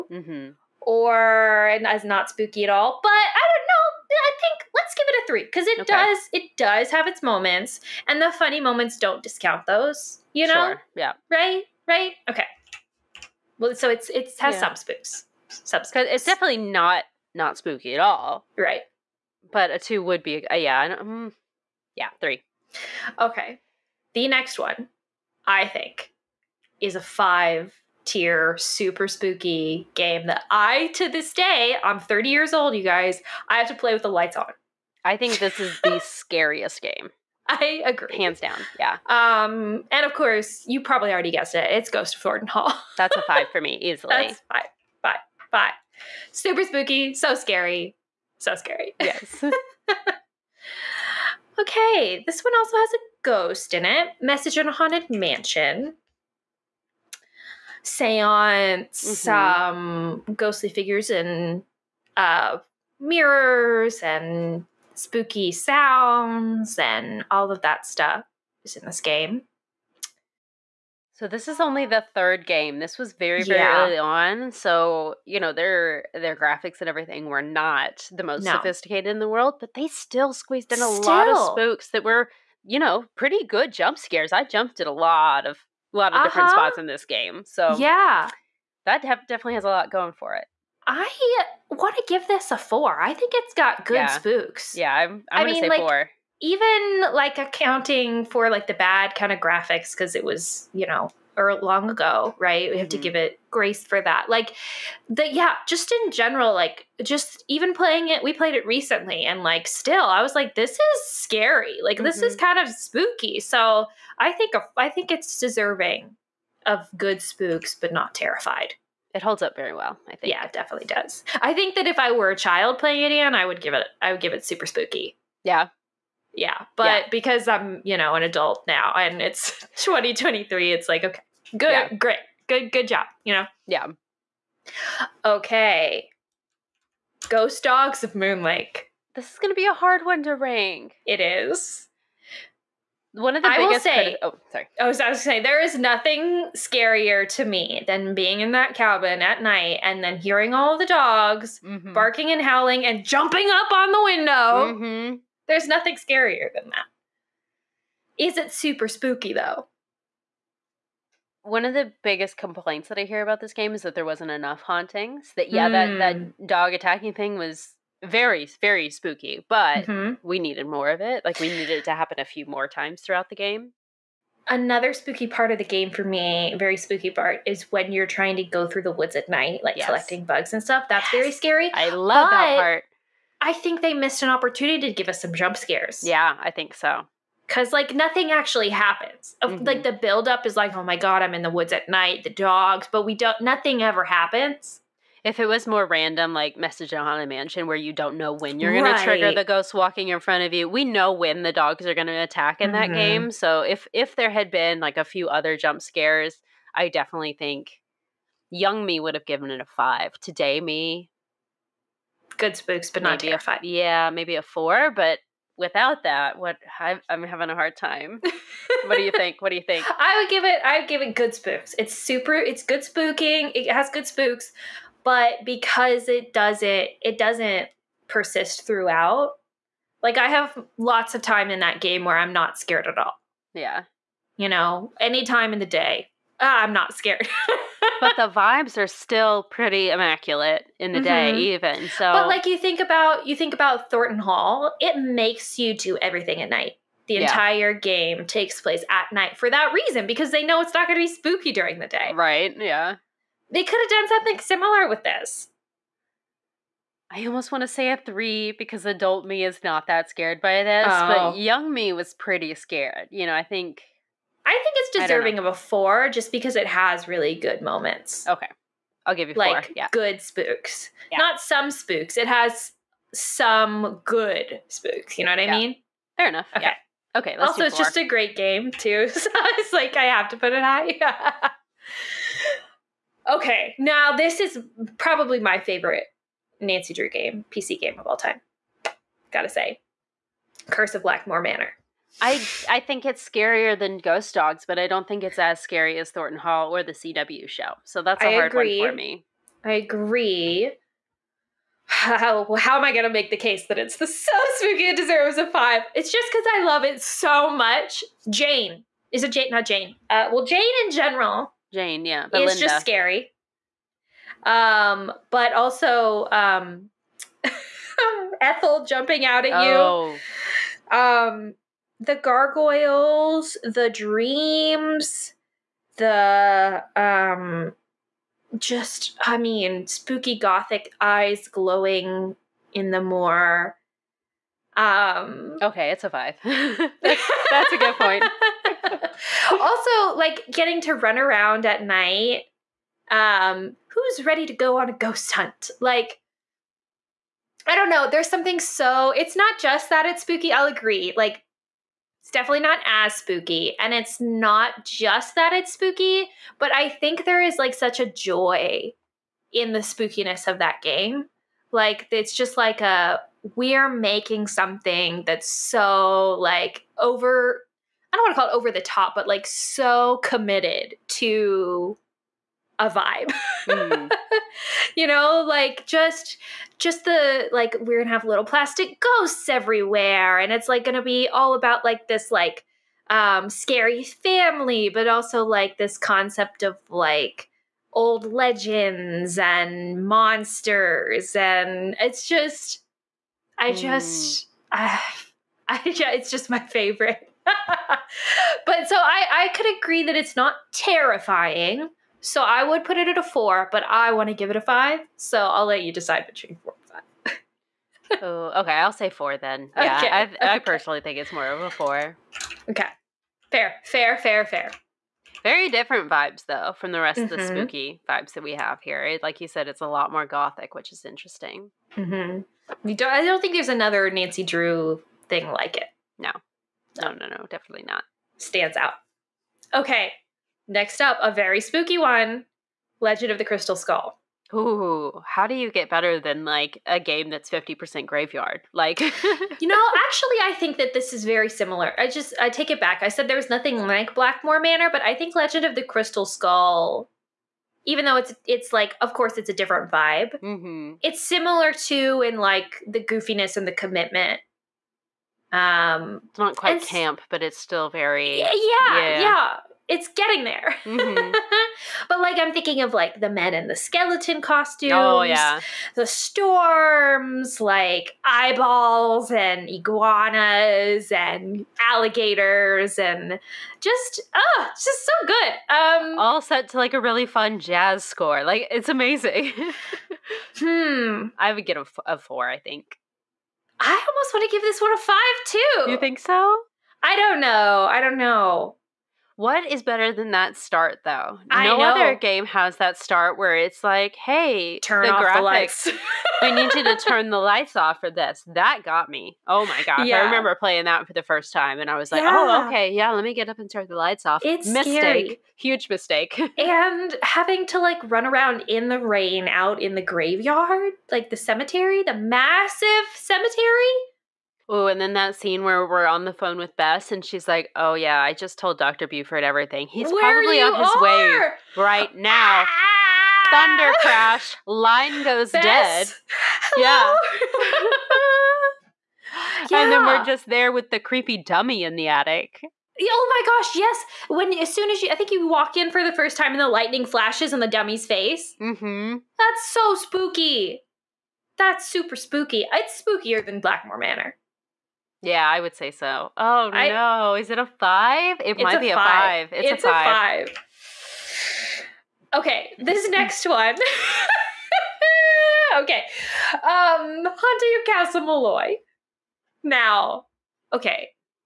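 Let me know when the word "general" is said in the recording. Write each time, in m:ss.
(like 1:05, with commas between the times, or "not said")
1:46, 5:10.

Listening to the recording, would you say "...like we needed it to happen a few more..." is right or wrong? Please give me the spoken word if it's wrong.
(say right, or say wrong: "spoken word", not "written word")
right.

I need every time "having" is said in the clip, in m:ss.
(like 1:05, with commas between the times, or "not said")
3:37, 8:27.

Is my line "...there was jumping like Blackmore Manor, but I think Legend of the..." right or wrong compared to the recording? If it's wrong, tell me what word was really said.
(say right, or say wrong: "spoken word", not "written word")
wrong: "nothing", not "jumping".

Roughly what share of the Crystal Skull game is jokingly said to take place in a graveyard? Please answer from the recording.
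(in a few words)
50%.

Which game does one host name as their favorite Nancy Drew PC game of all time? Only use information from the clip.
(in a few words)
Curse of Blackmore Manor.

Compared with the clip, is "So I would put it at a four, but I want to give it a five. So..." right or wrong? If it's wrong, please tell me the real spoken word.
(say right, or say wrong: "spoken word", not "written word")
right.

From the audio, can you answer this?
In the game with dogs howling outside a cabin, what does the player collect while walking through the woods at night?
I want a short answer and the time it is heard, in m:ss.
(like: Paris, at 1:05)
bugs, at 3:00.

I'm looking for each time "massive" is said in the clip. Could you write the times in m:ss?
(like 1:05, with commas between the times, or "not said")
8:32.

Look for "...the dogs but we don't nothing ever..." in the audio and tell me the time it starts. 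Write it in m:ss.
3:12.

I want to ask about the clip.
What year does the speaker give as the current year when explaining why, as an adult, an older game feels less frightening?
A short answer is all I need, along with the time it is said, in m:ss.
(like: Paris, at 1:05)
2023, at 2:09.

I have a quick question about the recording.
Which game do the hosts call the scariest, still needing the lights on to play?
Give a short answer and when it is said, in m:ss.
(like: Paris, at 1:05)
Ghost of Thornton Hall, at 0:41.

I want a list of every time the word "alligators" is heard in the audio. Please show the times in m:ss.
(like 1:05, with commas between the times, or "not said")
7:51.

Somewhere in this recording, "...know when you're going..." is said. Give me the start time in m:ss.
3:18.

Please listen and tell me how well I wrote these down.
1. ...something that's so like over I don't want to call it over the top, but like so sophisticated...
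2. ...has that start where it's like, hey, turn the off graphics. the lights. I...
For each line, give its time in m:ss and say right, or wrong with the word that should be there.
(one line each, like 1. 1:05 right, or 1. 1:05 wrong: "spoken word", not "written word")
1. 6:04 wrong: "committed", not "sophisticated"
2. 8:12 right.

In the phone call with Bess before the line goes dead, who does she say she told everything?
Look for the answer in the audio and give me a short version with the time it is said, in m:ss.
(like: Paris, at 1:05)
Dr. Buford, at 8:38.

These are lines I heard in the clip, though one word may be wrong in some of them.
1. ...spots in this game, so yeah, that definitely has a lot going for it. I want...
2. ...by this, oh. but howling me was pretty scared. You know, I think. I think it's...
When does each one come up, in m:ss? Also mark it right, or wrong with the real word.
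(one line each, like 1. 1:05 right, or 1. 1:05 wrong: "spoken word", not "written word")
1. 1:26 right
2. 4:20 wrong: "young", not "howling".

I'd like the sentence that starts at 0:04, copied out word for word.
I think give it a three because it okay.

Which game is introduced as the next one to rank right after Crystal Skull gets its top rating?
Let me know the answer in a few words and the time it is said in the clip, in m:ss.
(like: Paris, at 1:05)
Haunting of Castle Malloy, at 9:17.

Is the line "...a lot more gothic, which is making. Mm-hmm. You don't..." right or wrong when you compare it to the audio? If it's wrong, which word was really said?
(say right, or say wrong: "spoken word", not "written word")
wrong: "interesting", not "making".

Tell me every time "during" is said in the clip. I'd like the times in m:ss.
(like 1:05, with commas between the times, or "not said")
4:11.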